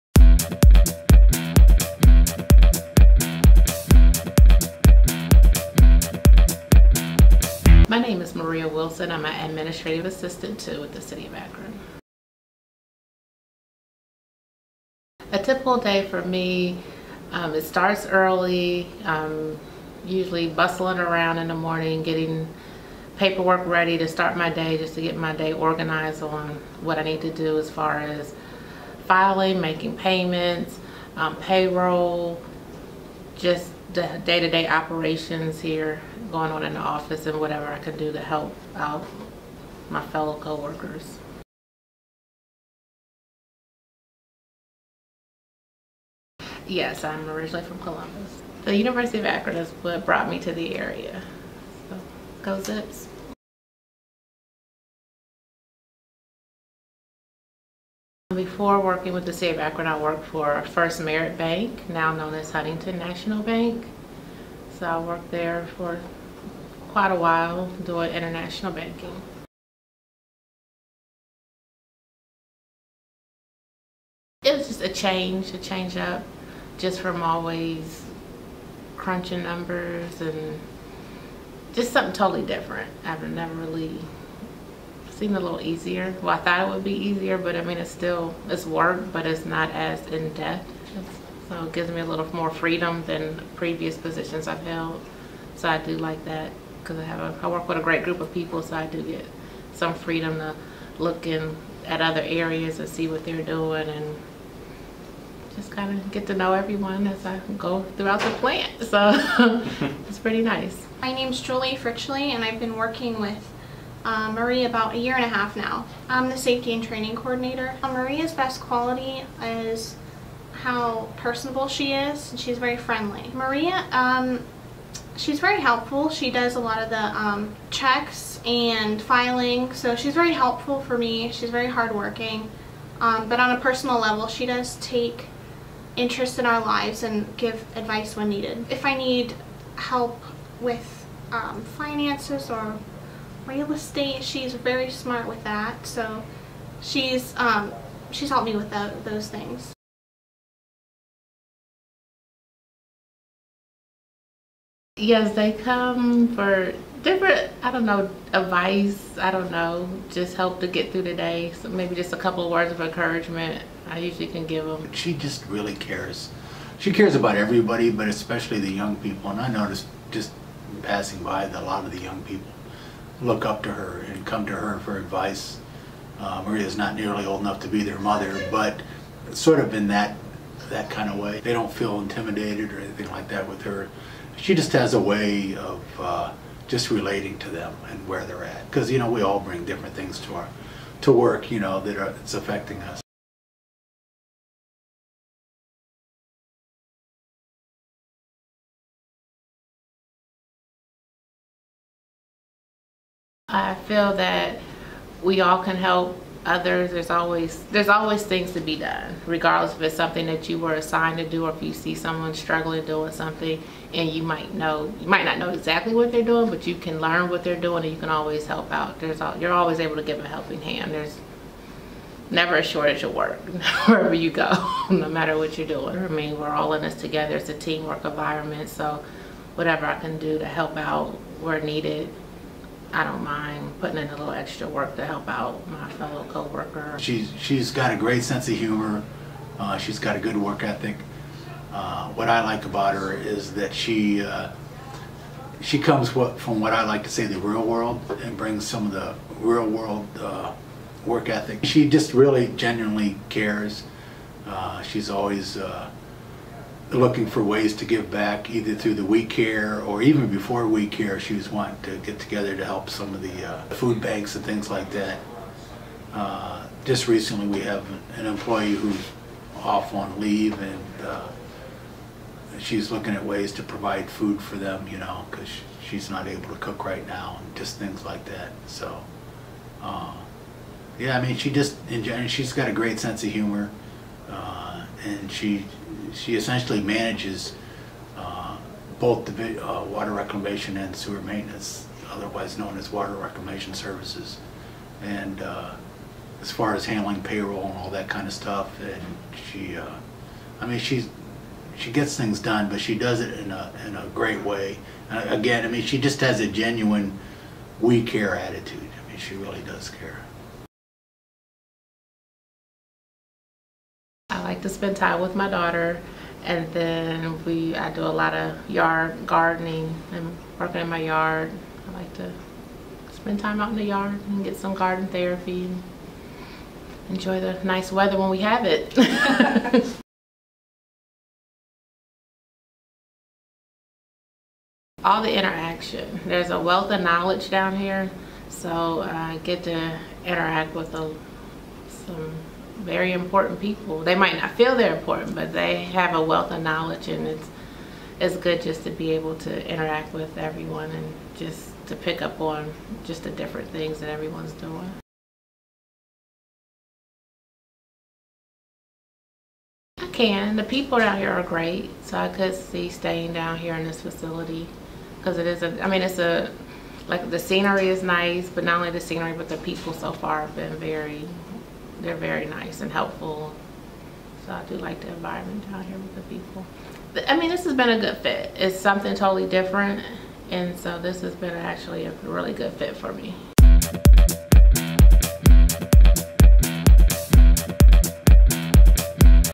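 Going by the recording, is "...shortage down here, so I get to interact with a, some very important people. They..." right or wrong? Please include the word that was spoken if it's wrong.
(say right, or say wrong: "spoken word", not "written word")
wrong: "knowledge", not "shortage".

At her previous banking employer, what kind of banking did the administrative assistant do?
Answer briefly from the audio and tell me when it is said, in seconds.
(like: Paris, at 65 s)
International banking, at 68 s.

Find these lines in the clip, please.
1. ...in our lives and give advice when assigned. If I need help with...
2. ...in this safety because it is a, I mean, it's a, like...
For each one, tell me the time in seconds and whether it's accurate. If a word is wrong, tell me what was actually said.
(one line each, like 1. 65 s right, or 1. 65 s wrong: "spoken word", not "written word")
1. 136 s wrong: "needed", not "assigned"
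2. 363 s wrong: "facility", not "safety".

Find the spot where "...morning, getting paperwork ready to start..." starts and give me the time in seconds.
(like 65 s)
21 s.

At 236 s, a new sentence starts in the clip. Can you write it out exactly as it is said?
She's she's got a great sense of humor.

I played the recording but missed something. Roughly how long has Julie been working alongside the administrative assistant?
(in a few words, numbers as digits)
A year and a half.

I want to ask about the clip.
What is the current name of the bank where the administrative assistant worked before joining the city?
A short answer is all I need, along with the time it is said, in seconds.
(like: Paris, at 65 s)
Huntington National Bank, at 62 s.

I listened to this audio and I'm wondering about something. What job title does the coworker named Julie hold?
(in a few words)
Safety and training coordinator.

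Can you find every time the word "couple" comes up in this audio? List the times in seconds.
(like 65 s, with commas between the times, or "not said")
162 s.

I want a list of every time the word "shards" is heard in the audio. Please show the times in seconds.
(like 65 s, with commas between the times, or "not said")
not said.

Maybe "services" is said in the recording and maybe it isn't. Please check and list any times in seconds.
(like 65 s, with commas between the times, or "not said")
293 s.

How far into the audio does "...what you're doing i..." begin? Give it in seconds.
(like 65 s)
225 s.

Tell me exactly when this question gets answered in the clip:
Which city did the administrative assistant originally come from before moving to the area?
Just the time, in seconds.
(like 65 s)
47 s.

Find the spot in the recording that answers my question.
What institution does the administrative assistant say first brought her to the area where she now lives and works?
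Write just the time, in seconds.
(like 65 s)
48 s.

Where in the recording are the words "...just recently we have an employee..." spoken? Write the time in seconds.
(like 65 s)
266 s.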